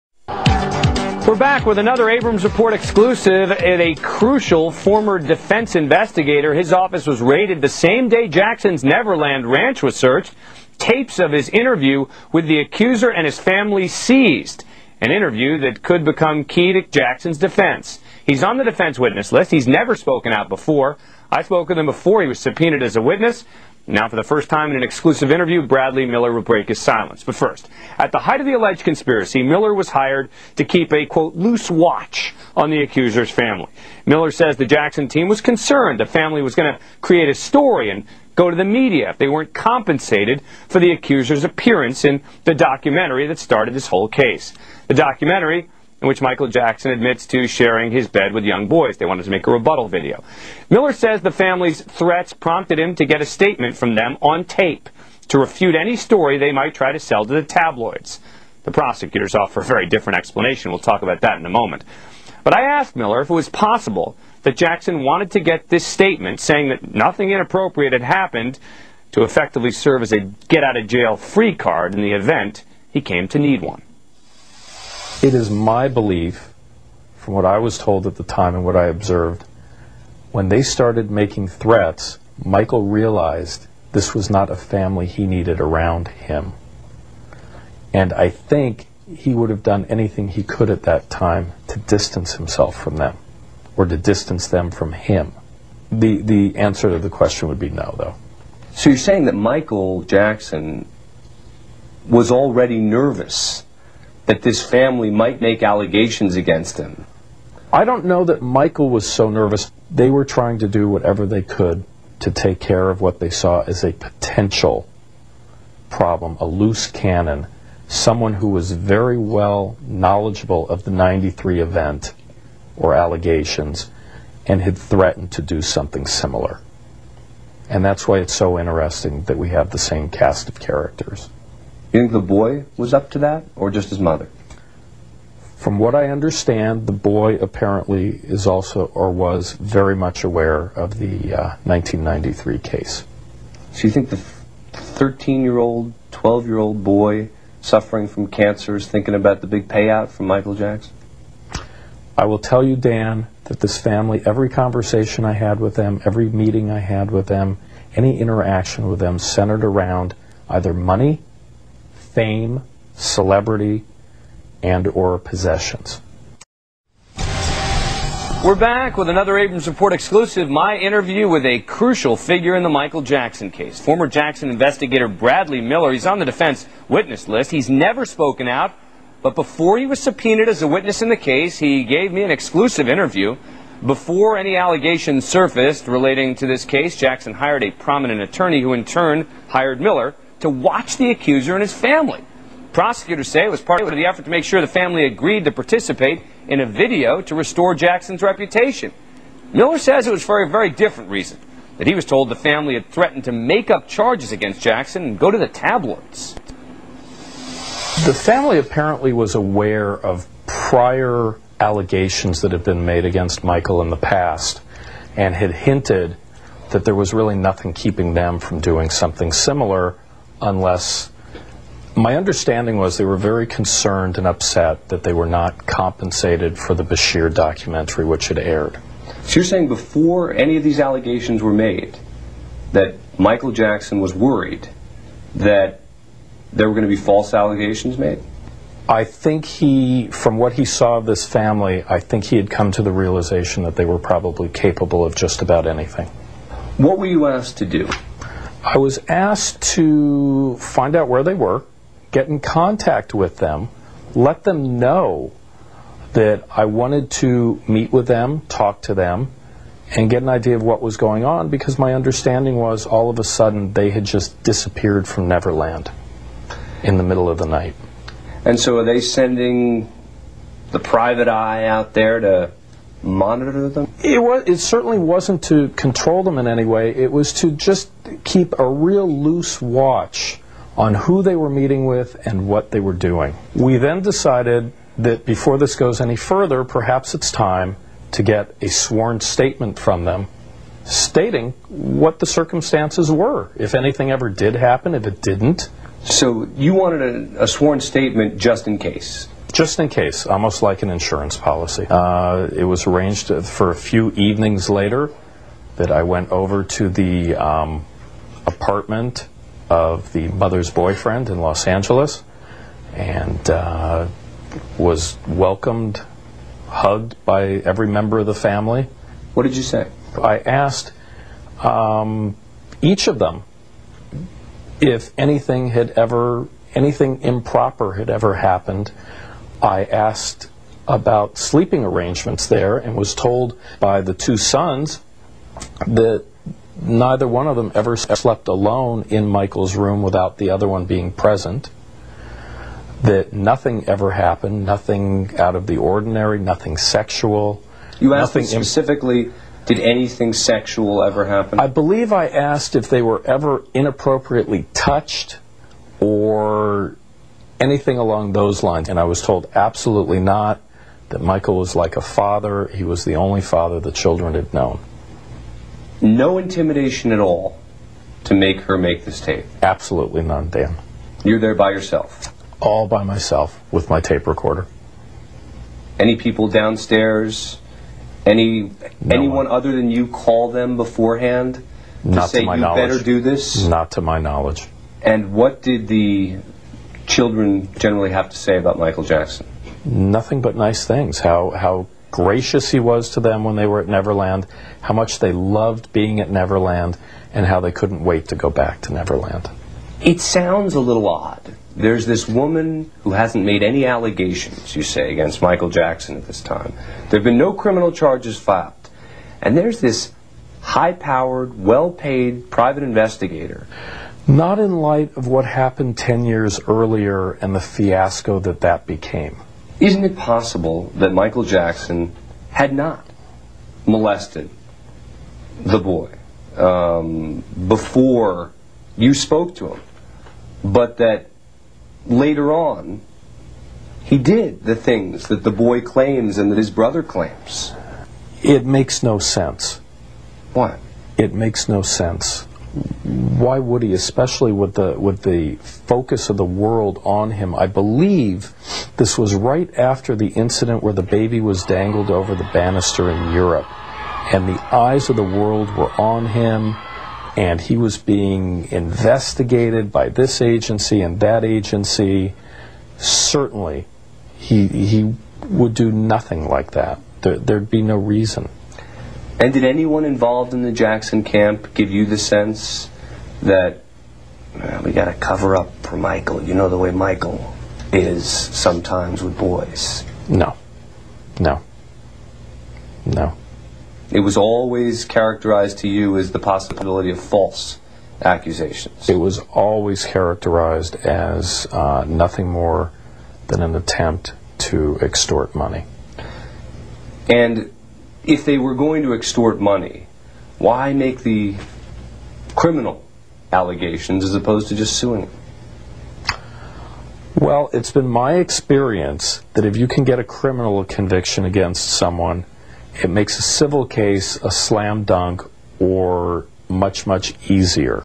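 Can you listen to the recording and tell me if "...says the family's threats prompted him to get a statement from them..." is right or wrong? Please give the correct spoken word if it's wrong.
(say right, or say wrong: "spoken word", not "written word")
right.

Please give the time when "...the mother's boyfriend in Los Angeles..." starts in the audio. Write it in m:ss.
5:10.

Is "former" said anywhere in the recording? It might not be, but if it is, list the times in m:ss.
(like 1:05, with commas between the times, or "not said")
0:04, 2:53.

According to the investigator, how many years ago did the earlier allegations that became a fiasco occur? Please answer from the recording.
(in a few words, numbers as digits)
10.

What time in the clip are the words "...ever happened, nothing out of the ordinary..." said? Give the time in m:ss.
5:43.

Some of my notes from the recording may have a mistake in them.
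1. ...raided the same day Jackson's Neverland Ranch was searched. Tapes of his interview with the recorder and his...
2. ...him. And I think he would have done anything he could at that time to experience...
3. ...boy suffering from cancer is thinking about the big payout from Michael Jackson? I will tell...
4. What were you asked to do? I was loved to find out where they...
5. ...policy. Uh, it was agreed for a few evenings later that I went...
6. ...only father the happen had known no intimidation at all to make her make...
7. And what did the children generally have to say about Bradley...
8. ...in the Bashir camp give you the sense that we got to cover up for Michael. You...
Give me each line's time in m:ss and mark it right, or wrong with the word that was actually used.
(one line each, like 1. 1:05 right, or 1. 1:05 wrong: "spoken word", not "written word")
1. 0:07 wrong: "accuser", not "recorder"
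2. 1:26 wrong: "distance", not "experience"
3. 2:26 right
4. 4:06 wrong: "asked", not "loved"
5. 5:01 wrong: "arranged", not "agreed"
6. 6:03 wrong: "children", not "happen"
7. 6:25 wrong: "Michael", not "Bradley"
8. 7:50 wrong: "Jackson", not "Bashir".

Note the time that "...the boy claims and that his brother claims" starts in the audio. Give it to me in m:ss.
7:15.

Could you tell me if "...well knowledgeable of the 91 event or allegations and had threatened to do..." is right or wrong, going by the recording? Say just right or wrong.
wrong.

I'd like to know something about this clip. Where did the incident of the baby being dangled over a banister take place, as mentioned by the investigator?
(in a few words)
Europe.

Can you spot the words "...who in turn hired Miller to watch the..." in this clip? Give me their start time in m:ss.
3:08.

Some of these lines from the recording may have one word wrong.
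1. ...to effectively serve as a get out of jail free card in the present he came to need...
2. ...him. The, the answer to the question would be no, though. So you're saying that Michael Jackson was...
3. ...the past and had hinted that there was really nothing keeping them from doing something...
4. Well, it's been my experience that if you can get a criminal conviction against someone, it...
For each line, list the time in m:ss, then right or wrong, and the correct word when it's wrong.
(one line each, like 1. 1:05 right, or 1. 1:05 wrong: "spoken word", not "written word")
1. 1:09 wrong: "event", not "present"
2. 1:34 right
3. 3:33 right
4. 8:27 right.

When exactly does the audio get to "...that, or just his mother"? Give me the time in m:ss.
2:13.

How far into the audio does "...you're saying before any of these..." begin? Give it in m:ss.
3:49.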